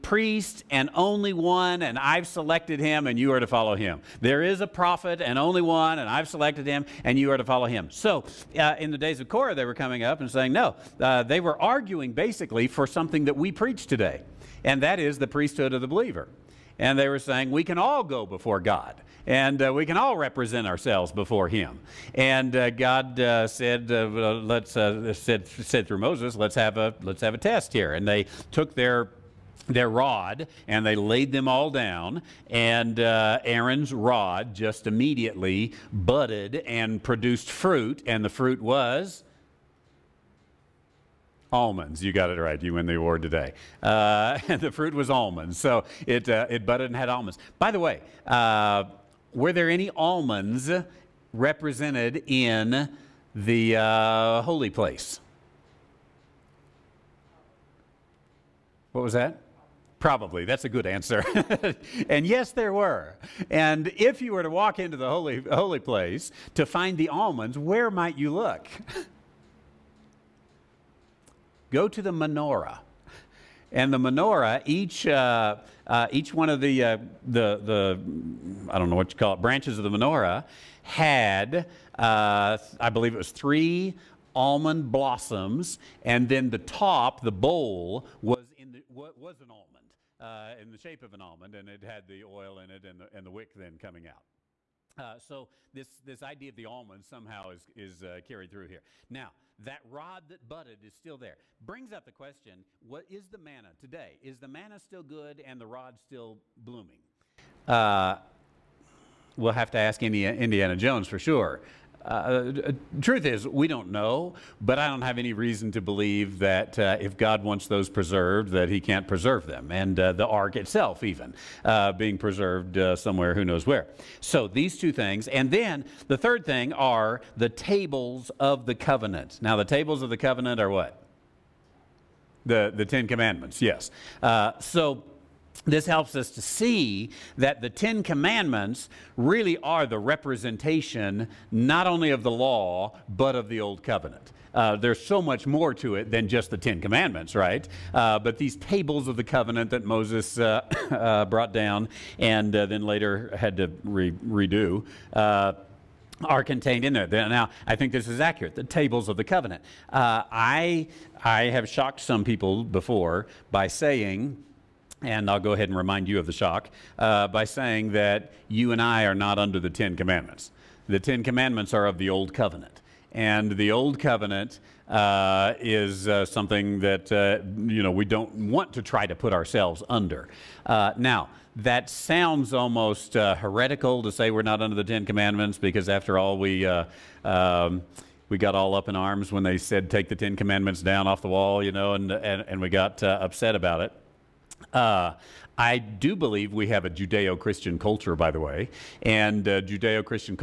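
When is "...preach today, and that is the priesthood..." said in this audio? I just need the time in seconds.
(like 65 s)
13 s.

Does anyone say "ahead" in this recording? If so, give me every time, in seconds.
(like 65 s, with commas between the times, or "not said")
165 s.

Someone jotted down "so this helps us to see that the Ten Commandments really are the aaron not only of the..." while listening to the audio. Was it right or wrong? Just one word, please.
wrong.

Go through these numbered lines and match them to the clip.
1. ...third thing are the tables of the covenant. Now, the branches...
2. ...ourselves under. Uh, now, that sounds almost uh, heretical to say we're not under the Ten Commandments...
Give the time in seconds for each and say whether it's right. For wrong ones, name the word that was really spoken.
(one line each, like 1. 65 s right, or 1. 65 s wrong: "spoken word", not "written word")
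1. 126 s wrong: "tables", not "branches"
2. 179 s right.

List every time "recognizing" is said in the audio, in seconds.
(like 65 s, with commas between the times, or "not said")
not said.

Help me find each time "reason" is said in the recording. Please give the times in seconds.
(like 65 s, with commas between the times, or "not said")
115 s.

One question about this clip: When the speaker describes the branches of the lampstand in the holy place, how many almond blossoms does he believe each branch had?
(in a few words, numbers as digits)
3.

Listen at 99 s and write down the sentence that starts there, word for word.
Now, that rod that budded is still there.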